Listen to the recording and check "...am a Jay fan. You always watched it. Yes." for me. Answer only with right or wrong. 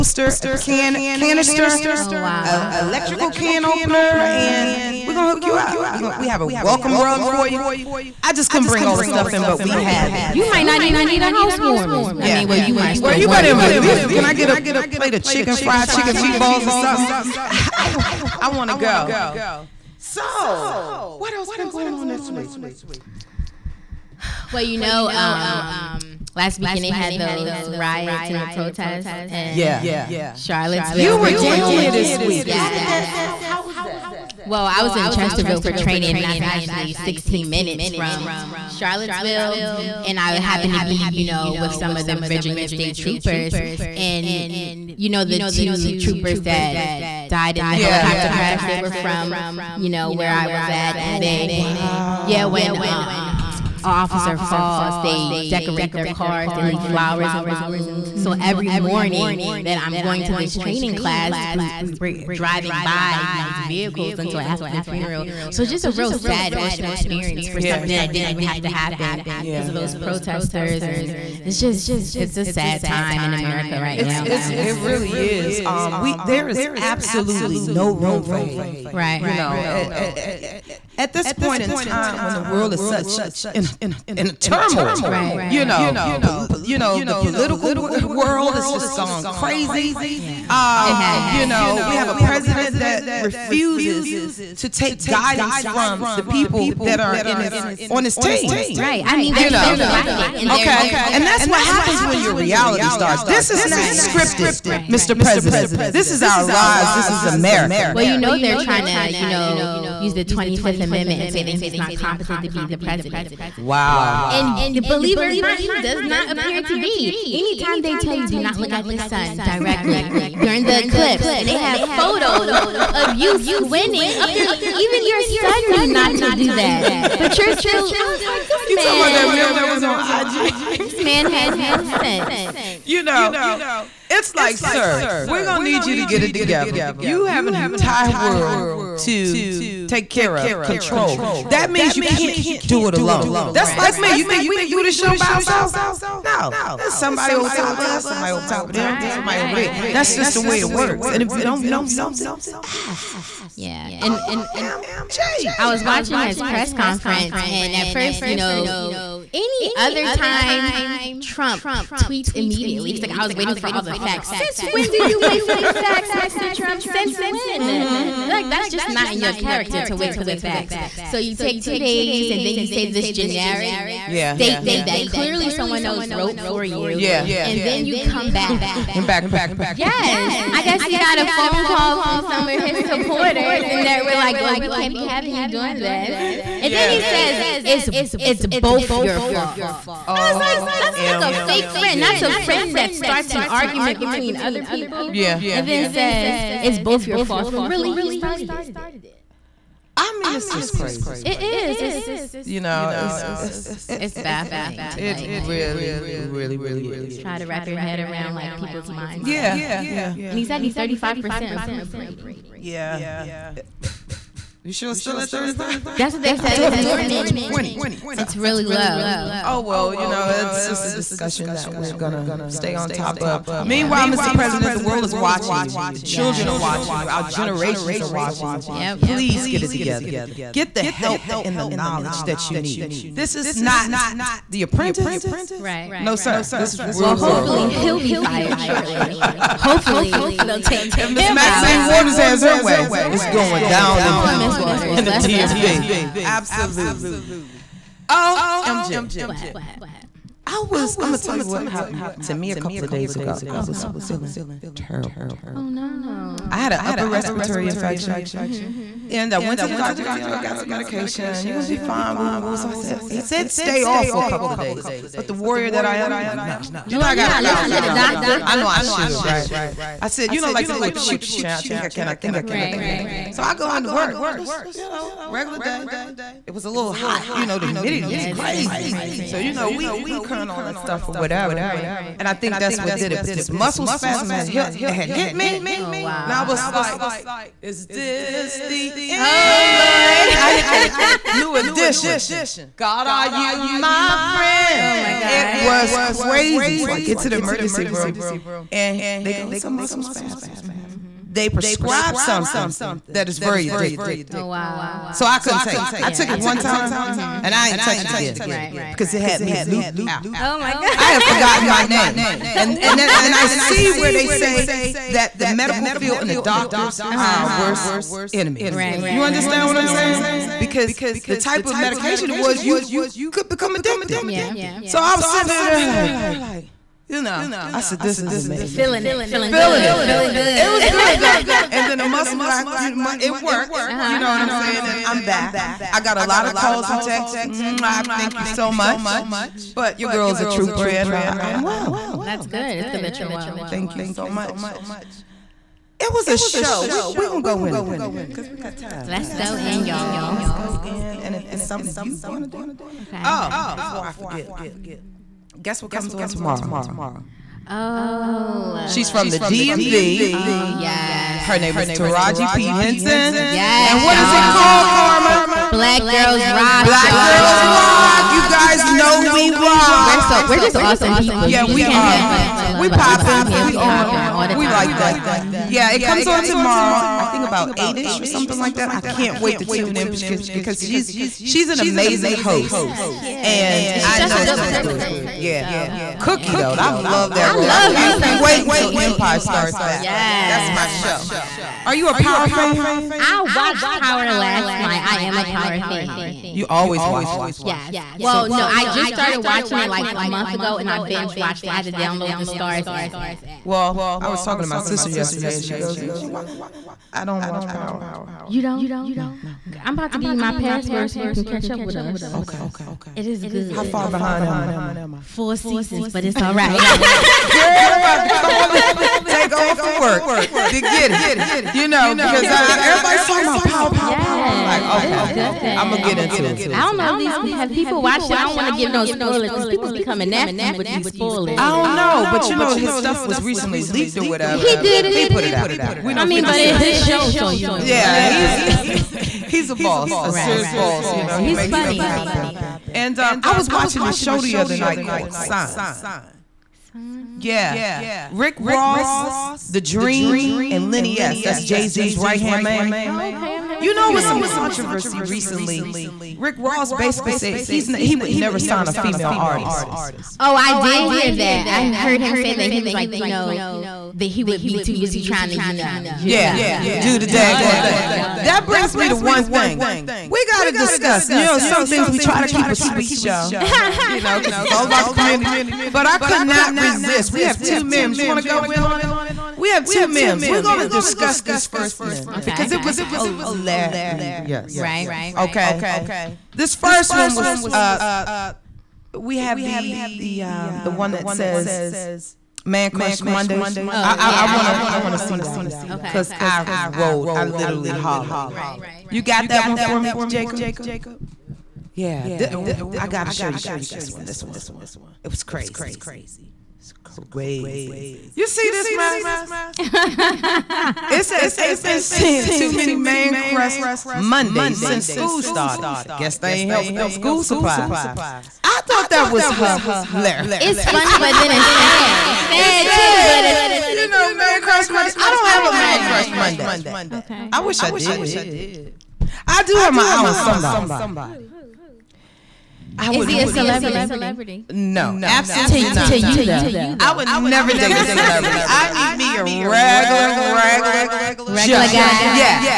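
wrong.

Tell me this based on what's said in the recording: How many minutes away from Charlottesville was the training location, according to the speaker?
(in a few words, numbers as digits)
16.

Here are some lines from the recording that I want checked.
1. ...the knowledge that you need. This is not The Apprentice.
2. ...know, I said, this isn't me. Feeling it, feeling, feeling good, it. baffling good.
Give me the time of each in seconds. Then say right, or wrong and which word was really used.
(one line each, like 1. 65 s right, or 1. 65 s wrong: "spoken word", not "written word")
1. 231 s right
2. 327 s wrong: "feeling", not "baffling".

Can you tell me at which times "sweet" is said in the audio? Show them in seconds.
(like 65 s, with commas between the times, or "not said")
472 s.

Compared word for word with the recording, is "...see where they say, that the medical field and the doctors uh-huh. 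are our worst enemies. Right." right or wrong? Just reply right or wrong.
right.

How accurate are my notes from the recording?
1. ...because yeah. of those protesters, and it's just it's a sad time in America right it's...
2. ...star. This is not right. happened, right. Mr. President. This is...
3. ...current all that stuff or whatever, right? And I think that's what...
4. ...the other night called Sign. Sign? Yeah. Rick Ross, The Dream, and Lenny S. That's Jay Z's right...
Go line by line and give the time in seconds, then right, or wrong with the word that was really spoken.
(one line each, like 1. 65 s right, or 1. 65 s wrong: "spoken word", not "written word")
1. 69 s right
2. 102 s wrong: "scripted", not "happened"
3. 280 s right
4. 444 s right.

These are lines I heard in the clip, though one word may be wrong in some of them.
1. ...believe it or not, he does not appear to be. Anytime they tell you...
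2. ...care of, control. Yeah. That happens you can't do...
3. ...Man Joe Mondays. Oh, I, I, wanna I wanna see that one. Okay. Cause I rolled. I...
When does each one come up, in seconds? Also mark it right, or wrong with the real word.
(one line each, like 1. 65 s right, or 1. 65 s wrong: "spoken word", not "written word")
1. 114 s right
2. 140 s wrong: "means", not "happens"
3. 492 s wrong: "Crush", not "Joe".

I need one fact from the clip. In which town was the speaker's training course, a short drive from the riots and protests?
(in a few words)
Chesterville.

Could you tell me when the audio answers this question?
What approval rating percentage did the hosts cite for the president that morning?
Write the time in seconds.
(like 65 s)
210 s.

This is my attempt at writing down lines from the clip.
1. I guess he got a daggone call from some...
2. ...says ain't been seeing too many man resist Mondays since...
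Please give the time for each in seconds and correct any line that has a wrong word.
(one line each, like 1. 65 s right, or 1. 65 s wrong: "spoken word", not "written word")
1. 180 s wrong: "phone", not "daggone"
2. 511 s wrong: "crust", not "resist".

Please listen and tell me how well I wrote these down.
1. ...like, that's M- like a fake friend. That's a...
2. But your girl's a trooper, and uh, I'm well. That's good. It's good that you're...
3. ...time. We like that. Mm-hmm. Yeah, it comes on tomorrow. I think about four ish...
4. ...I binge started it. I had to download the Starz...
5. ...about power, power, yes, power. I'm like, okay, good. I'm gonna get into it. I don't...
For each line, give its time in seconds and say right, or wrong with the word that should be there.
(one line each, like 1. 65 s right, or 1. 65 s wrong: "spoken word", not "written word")
1. 190 s right
2. 339 s right
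3. 374 s wrong: "eight", not "four"
4. 400 s wrong: "watched", not "started"
5. 423 s right.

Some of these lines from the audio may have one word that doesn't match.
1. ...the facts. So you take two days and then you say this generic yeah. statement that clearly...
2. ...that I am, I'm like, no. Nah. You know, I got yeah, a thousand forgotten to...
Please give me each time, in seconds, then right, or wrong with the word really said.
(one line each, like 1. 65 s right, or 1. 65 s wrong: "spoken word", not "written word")
1. 170 s right
2. 265 s wrong: "listen", not "forgotten".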